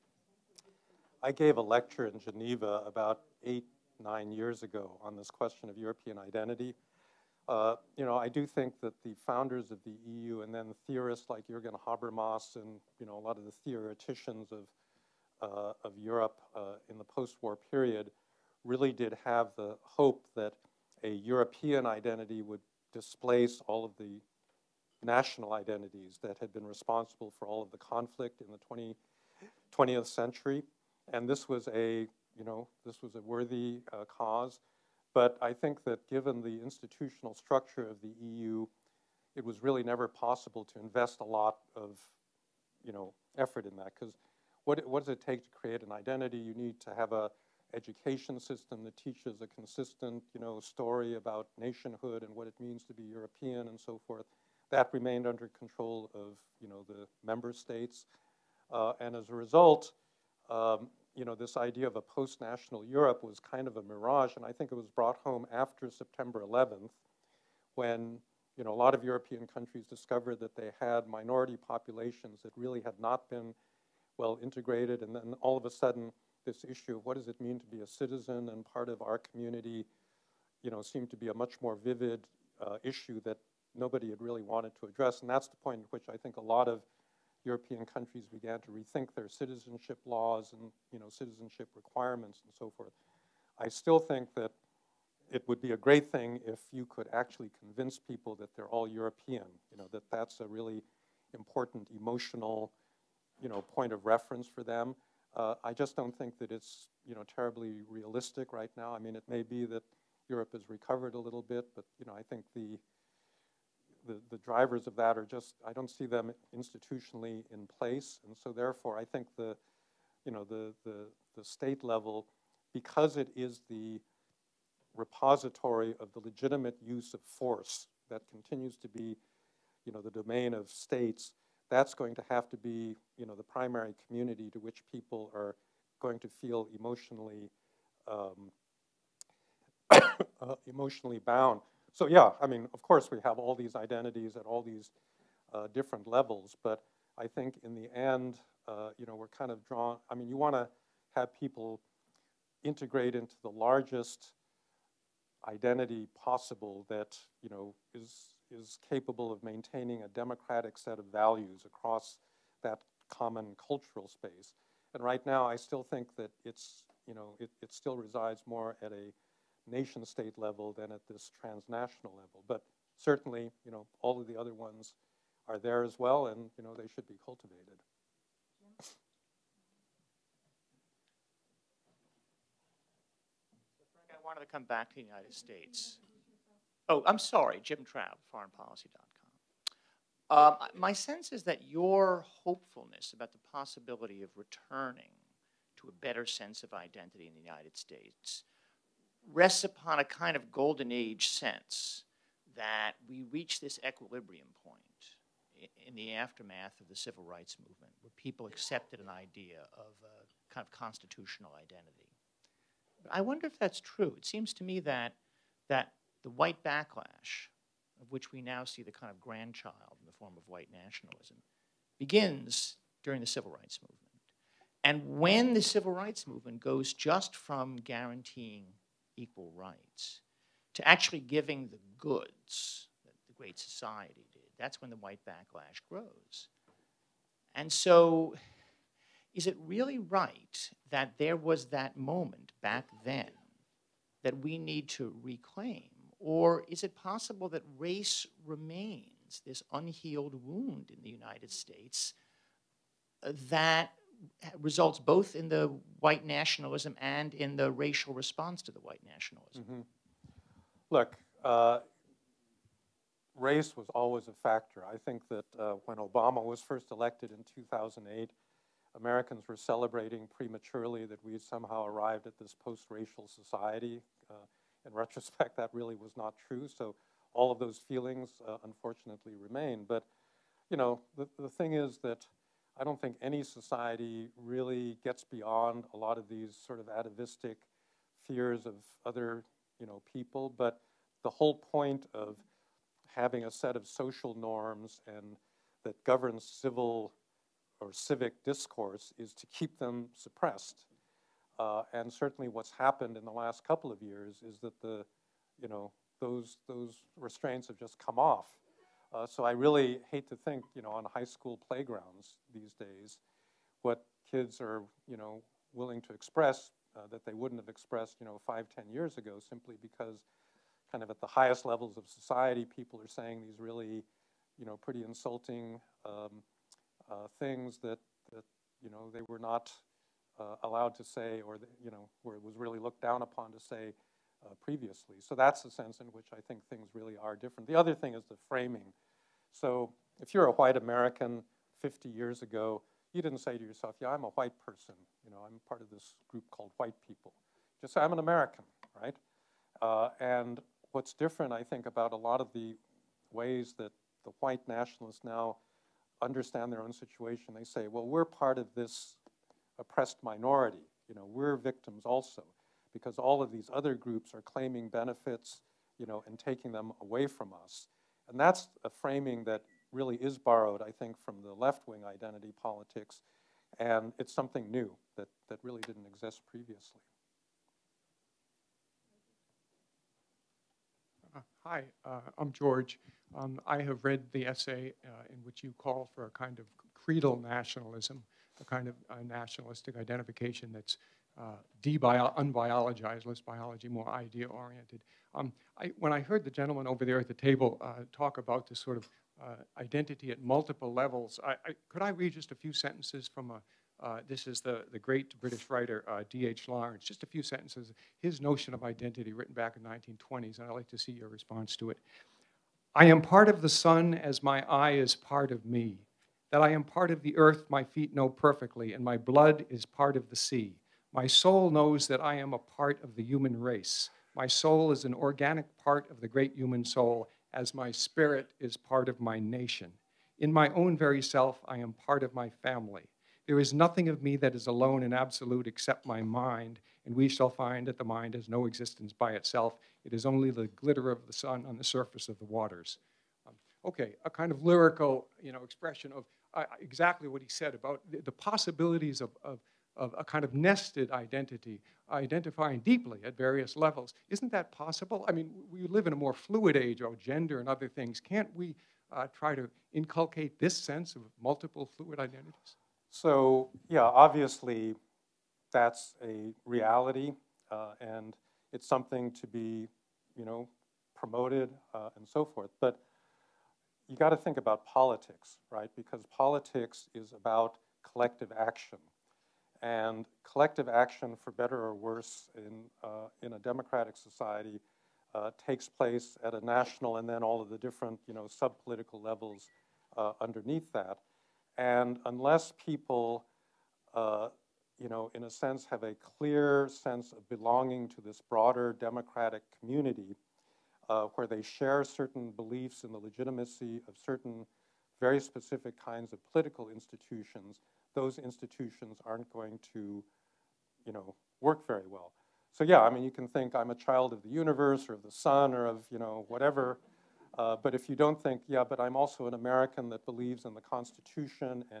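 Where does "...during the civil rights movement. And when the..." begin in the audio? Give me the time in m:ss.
3:43.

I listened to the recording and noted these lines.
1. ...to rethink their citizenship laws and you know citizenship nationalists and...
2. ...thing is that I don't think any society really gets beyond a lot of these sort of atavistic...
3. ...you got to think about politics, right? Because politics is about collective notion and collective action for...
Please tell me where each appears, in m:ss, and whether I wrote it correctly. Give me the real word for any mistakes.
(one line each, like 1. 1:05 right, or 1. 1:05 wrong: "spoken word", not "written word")
1. 1:28 wrong: "requirements", not "nationalists"
2. 4:41 right
3. 7:54 wrong: "action", not "notion".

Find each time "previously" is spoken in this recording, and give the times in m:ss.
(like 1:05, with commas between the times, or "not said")
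5:34, 6:16.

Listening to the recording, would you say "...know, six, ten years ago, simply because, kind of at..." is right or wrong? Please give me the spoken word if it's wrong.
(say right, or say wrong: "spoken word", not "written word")
wrong: "five", not "six".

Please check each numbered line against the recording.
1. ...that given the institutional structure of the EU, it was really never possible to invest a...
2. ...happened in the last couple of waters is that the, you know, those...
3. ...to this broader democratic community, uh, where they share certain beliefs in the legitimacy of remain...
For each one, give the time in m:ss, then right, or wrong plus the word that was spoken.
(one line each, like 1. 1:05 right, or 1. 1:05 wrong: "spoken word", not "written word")
1. 0:35 right
2. 5:02 wrong: "years", not "waters"
3. 8:18 wrong: "certain", not "remain".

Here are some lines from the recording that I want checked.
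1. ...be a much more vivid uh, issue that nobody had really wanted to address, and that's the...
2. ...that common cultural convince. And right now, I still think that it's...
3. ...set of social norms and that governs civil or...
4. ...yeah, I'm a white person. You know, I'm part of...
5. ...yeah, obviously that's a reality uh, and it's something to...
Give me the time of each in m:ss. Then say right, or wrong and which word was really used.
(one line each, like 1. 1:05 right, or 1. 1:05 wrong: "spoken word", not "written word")
1. 1:21 right
2. 2:42 wrong: "space", not "convince"
3. 4:53 right
4. 5:44 right
5. 7:43 right.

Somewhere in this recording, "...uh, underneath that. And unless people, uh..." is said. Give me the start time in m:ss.
8:10.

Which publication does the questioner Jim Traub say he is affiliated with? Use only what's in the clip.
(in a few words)
foreignpolicy.com.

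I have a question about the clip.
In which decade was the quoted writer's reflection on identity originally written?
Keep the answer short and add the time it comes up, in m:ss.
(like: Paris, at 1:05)
1920s, at 6:49.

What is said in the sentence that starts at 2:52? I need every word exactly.
But certainly, you know, all of the other ones are there as well, and you know, they should be cultivated.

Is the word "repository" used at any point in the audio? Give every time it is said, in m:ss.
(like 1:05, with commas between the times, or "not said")
2:04.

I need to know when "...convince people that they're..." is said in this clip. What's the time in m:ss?
1:37.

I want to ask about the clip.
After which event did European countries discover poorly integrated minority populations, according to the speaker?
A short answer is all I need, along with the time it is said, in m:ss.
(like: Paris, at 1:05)
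September 11th, at 1:05.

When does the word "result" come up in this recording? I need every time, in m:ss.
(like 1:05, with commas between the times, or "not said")
0:59, 4:14.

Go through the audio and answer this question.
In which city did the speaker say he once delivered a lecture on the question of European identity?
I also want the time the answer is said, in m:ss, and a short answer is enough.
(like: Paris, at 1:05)
Geneva, at 0:02.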